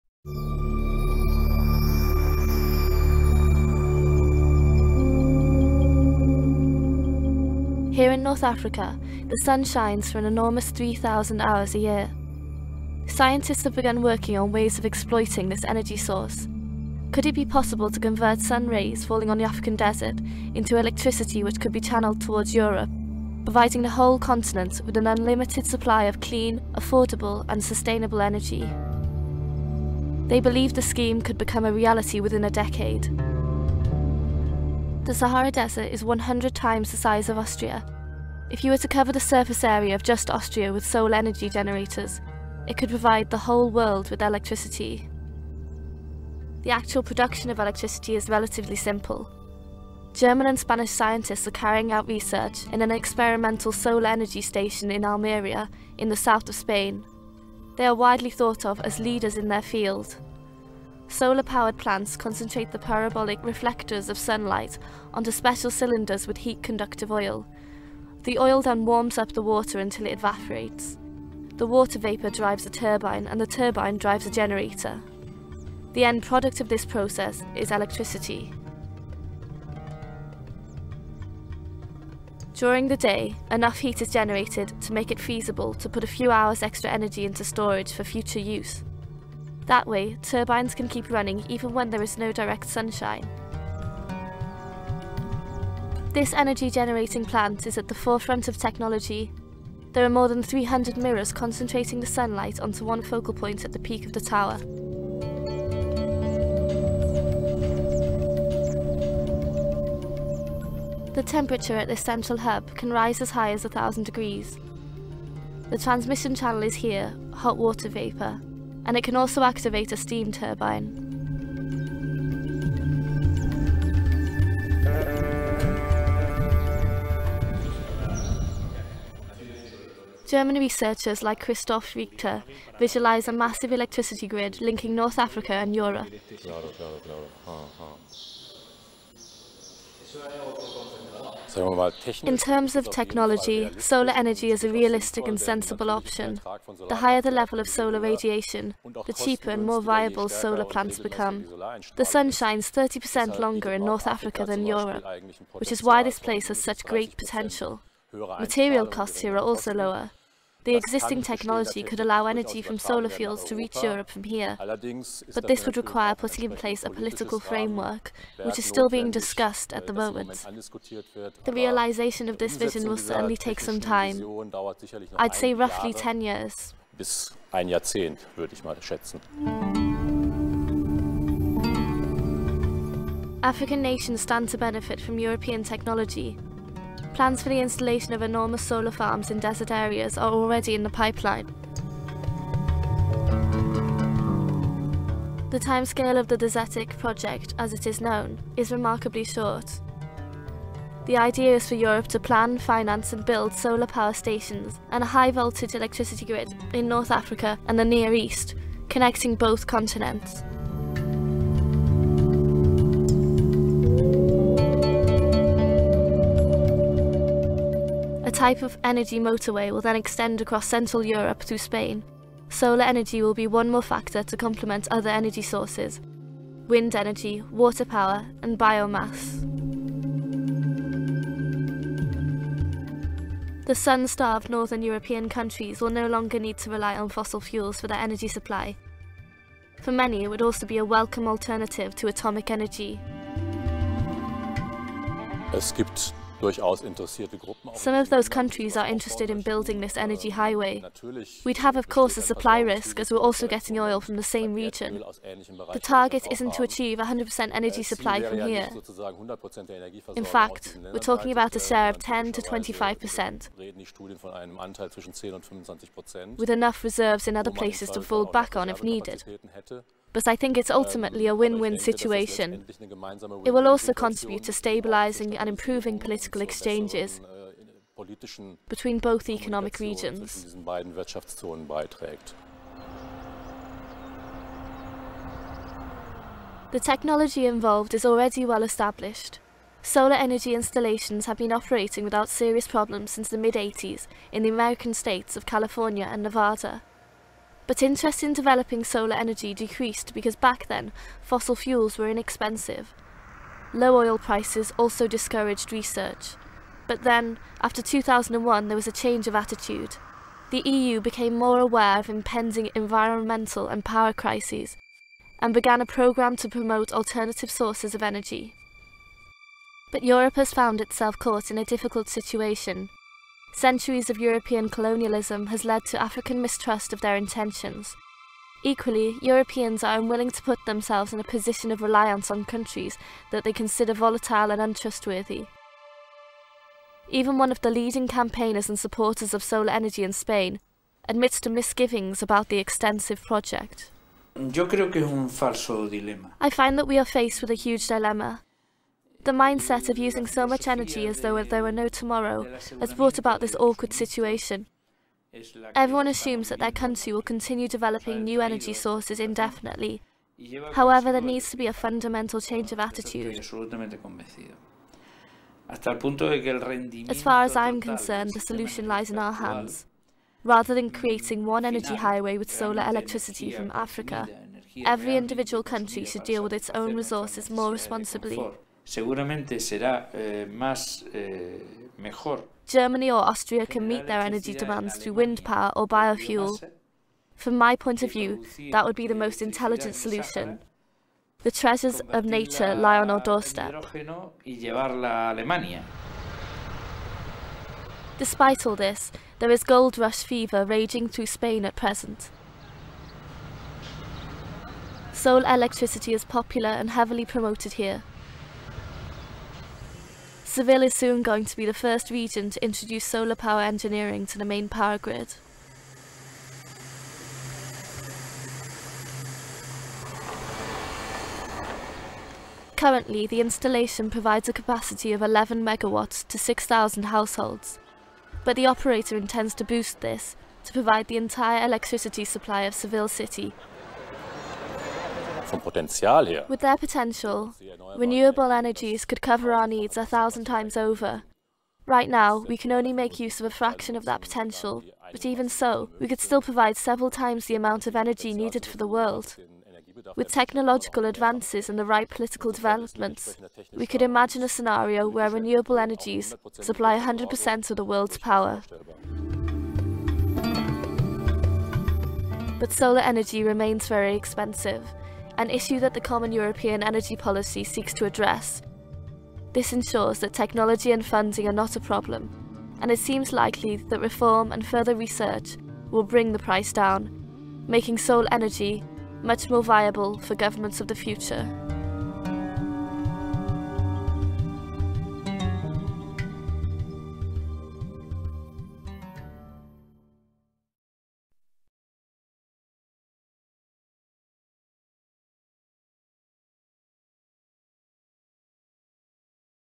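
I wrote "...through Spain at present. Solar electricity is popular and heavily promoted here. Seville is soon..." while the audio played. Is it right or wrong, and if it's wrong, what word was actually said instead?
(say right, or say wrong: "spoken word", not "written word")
right.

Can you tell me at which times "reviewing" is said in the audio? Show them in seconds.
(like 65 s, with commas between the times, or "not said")
not said.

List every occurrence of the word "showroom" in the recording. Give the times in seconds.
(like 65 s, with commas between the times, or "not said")
not said.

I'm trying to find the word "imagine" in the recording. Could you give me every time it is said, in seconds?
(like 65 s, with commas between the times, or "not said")
454 s.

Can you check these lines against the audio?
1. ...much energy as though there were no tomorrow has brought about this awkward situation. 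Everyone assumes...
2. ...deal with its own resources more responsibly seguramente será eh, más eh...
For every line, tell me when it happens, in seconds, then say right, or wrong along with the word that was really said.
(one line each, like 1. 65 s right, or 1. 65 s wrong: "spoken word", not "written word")
1. 350 s right
2. 376 s right.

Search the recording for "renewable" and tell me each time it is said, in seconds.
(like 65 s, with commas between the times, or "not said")
437 s, 455 s.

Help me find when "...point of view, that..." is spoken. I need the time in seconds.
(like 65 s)
387 s.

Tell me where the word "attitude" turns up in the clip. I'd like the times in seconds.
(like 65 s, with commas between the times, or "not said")
309 s, 362 s.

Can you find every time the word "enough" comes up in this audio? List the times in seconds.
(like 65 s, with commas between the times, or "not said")
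83 s, 266 s.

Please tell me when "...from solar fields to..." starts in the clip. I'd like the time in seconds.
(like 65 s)
162 s.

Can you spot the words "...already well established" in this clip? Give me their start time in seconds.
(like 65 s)
288 s.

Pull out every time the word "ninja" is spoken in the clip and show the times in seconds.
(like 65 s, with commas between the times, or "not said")
not said.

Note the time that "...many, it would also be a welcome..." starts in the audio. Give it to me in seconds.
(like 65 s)
239 s.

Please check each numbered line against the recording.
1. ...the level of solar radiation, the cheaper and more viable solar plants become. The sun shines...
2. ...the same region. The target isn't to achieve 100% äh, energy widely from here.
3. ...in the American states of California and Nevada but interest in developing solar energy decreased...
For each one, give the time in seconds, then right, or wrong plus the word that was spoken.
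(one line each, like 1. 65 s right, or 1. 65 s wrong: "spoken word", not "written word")
1. 147 s right
2. 254 s wrong: "supply", not "widely"
3. 294 s right.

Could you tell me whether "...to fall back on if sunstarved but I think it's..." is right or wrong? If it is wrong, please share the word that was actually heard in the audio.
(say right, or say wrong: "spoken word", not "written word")
wrong: "needed", not "sunstarved".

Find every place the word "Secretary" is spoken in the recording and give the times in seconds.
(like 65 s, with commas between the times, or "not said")
not said.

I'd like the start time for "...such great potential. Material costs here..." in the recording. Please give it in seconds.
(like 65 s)
156 s.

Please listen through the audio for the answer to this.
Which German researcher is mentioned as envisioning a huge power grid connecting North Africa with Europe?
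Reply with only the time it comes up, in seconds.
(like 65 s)
131 s.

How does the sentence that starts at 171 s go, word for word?
The realization of this vision will certainly take some time.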